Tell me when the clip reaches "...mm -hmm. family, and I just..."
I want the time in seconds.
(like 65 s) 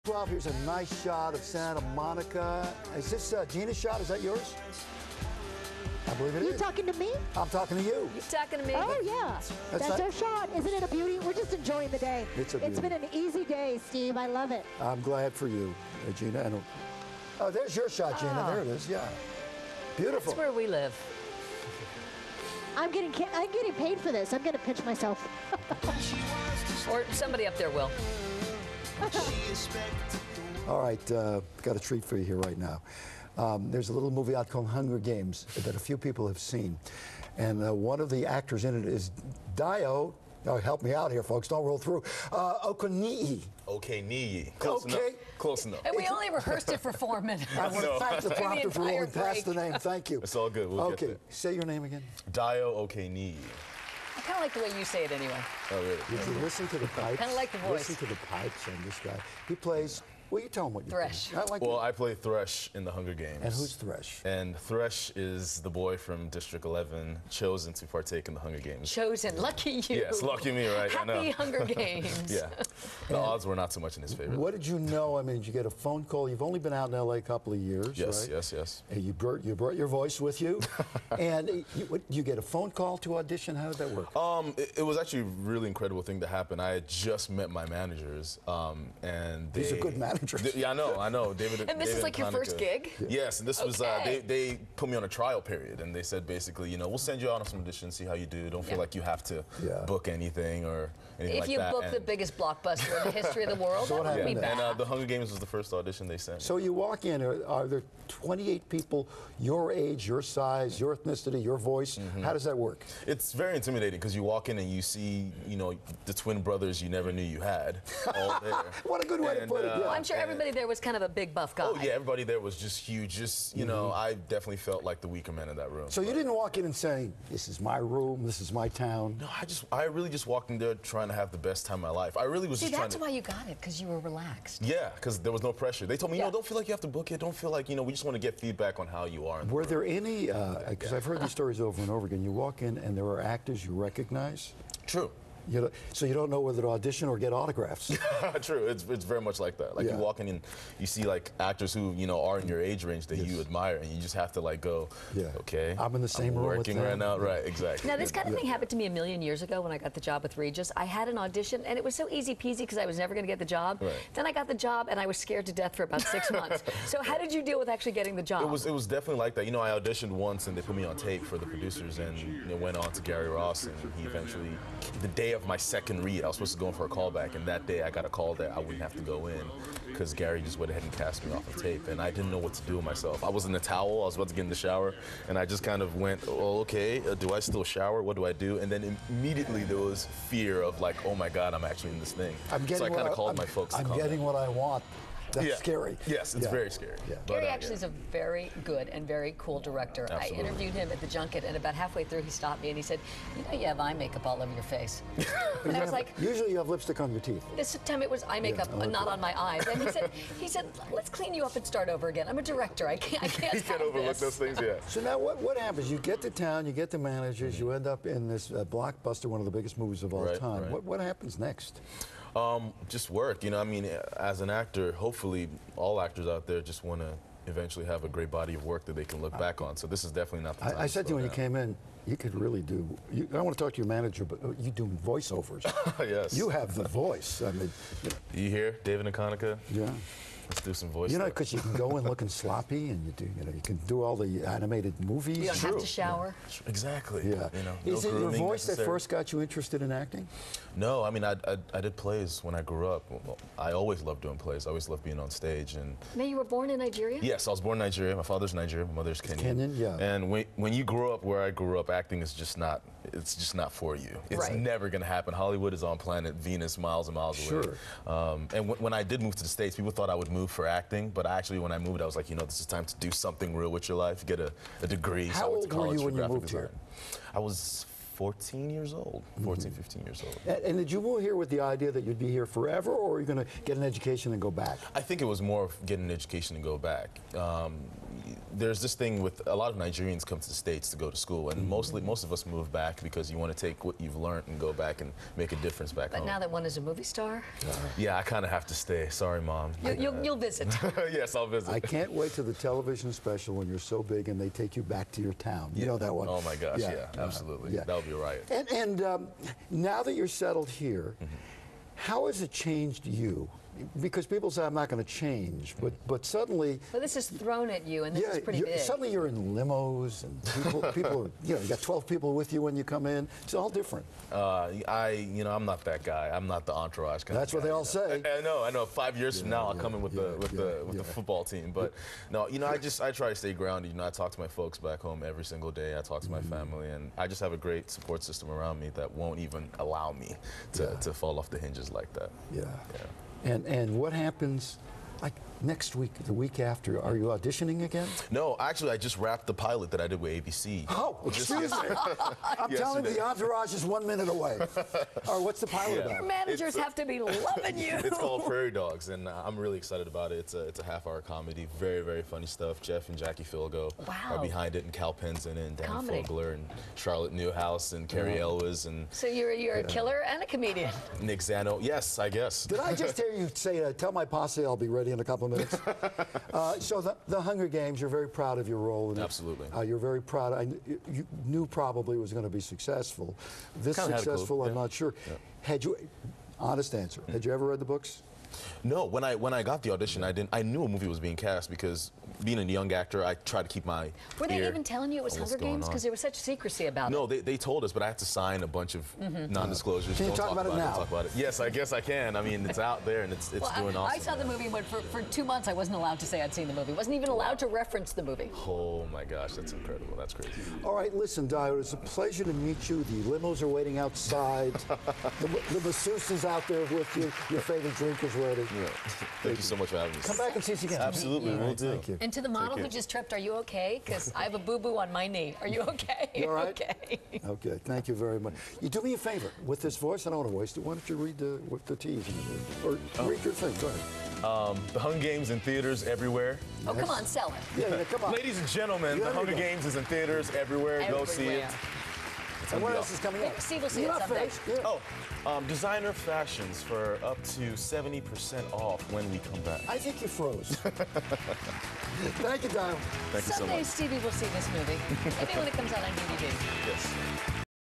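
336 s.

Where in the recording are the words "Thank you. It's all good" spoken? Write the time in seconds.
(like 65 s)
49 s.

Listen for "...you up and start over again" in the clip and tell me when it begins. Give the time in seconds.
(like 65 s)
211 s.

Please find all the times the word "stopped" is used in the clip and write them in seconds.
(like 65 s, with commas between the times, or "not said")
202 s.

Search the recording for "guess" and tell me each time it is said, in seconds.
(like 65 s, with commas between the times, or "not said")
372 s, 401 s.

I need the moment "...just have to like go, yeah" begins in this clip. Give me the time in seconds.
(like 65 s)
154 s.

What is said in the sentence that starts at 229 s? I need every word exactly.
So this is definitely not the time.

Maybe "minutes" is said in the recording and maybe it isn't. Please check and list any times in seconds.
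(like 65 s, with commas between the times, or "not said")
47 s, 354 s, 375 s.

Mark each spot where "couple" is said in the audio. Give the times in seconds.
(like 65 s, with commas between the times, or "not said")
77 s, 375 s.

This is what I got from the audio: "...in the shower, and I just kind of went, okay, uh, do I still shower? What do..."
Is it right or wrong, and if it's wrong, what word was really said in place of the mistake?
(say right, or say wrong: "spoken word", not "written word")
right.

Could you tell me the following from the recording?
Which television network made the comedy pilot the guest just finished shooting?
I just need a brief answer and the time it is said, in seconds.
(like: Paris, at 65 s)
ABC, at 350 s.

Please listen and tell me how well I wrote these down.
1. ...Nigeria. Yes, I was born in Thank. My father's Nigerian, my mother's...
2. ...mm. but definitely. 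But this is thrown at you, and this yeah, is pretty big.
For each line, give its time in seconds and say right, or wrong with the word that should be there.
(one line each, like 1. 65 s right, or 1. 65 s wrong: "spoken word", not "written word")
1. 256 s wrong: "Nigeria", not "Thank"
2. 315 s wrong: "suddenly", not "definitely".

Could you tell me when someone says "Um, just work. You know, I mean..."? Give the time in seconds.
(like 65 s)
222 s.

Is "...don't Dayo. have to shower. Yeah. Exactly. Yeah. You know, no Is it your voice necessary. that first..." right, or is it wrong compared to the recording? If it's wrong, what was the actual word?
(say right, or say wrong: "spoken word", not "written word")
wrong: "True", not "Dayo".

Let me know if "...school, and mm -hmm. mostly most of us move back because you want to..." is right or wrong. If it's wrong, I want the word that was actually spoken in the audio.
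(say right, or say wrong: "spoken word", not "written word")
right.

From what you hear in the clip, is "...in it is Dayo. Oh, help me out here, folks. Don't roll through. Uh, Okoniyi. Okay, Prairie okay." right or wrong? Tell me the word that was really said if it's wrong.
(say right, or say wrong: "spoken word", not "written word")
wrong: "Close", not "Prairie".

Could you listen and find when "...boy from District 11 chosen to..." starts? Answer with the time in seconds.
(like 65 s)
65 s.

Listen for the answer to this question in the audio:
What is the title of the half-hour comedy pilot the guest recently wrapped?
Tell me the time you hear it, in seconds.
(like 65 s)
358 s.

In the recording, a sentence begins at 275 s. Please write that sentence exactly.
How so old were you when you moved design.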